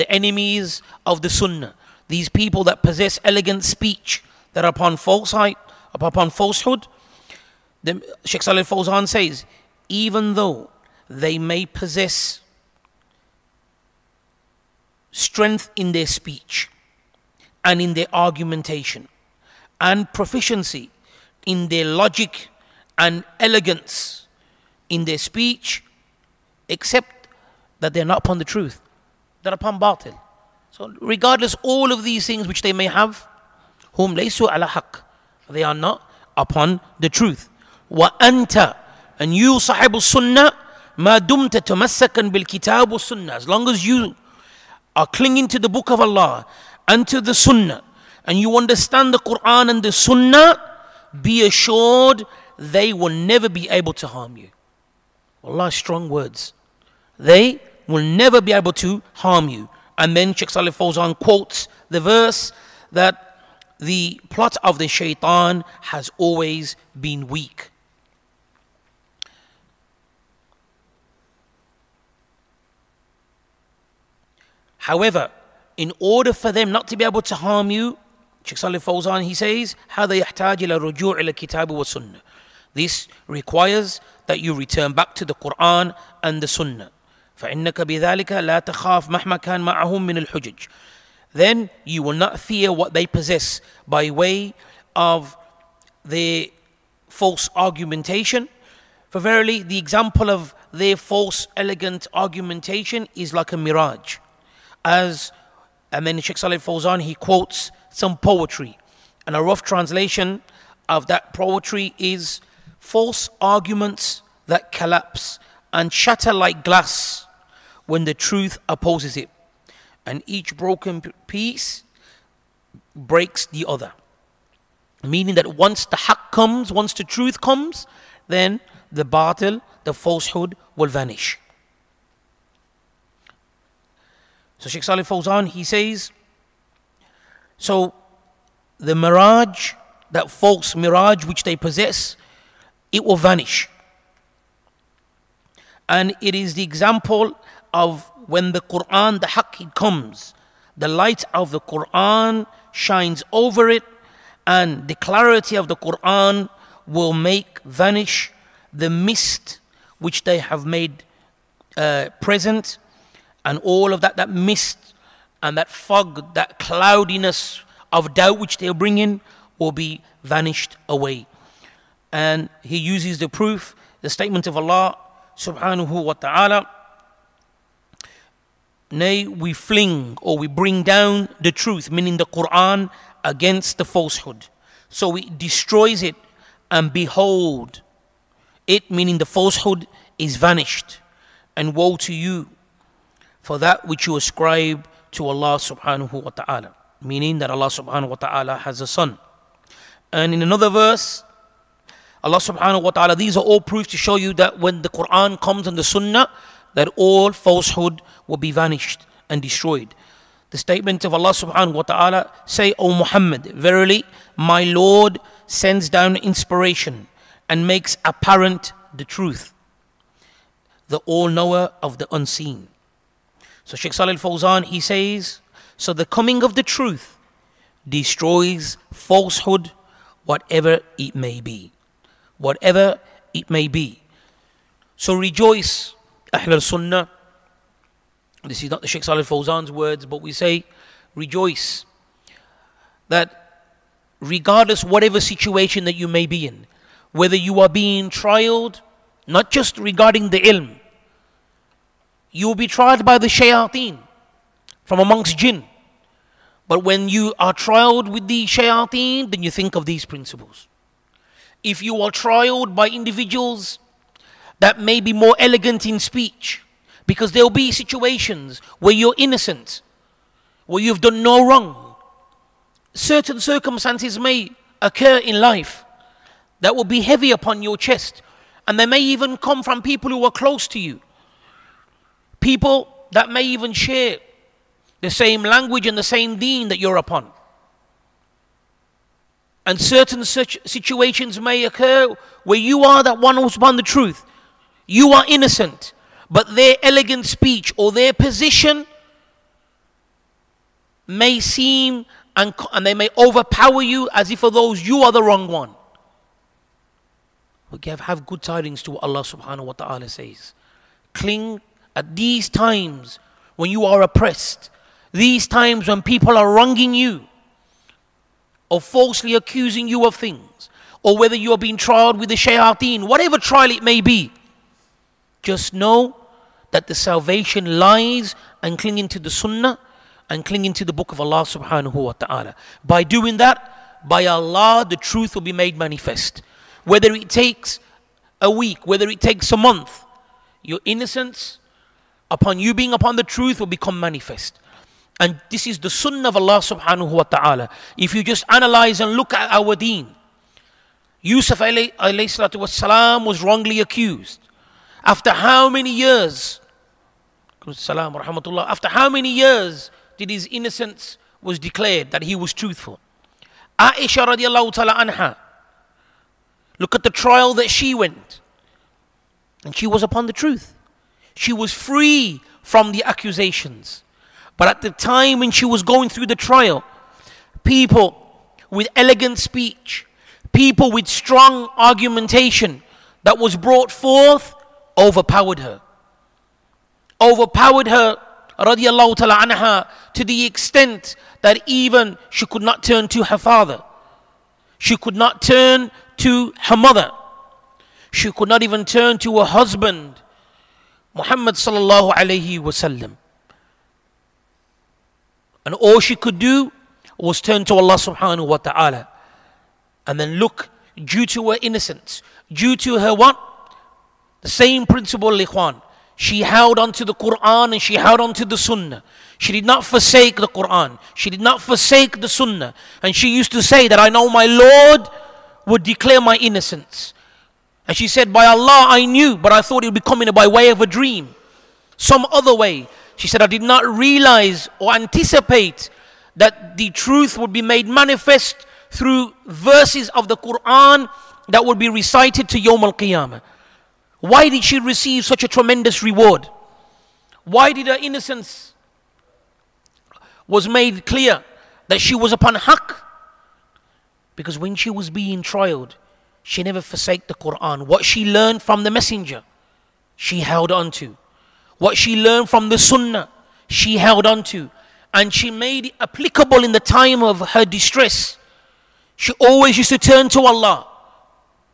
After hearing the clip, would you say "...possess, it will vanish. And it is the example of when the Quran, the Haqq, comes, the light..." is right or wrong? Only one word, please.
right.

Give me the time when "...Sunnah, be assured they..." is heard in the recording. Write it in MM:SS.
00:49.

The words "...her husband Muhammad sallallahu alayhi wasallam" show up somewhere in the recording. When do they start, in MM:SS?
06:39.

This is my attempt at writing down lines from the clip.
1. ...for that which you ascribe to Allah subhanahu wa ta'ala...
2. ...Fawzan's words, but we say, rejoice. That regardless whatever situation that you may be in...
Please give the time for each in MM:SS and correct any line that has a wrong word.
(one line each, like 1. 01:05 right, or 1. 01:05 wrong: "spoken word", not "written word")
1. 03:13 right
2. 03:59 right.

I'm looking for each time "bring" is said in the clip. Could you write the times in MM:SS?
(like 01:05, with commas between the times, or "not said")
02:48, 03:00.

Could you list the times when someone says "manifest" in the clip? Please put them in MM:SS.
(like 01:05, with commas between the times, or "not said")
05:35, 05:43, 07:17.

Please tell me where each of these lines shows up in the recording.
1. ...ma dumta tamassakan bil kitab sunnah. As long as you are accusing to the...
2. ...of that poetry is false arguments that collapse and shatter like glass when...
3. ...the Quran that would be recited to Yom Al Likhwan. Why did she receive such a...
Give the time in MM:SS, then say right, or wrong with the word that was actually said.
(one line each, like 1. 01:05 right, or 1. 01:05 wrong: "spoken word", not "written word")
1. 00:40 wrong: "clinging", not "accusing"
2. 01:50 right
3. 07:20 wrong: "Qiyamah", not "Likhwan".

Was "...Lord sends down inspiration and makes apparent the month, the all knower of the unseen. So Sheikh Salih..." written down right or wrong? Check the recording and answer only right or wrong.
wrong.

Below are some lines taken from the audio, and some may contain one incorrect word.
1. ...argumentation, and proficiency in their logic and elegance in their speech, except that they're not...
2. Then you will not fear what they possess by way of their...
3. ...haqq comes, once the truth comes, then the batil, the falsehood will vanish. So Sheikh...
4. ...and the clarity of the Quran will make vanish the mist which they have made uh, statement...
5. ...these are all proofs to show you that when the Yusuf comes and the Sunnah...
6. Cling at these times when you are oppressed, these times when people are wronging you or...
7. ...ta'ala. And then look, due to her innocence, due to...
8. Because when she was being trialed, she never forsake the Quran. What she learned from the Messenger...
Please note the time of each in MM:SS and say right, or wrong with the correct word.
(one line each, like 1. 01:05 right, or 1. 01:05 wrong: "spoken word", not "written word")
1. 00:18 right
2. 01:31 right
3. 02:05 right
4. 02:34 wrong: "present", not "statement"
5. 03:23 wrong: "Quran", not "Yusuf"
6. 05:11 right
7. 06:48 right
8. 07:34 right.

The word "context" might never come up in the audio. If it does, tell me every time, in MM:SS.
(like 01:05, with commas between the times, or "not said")
not said.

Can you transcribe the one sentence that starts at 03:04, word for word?
So it destroys it, and behold, it, meaning the falsehood, is vanished.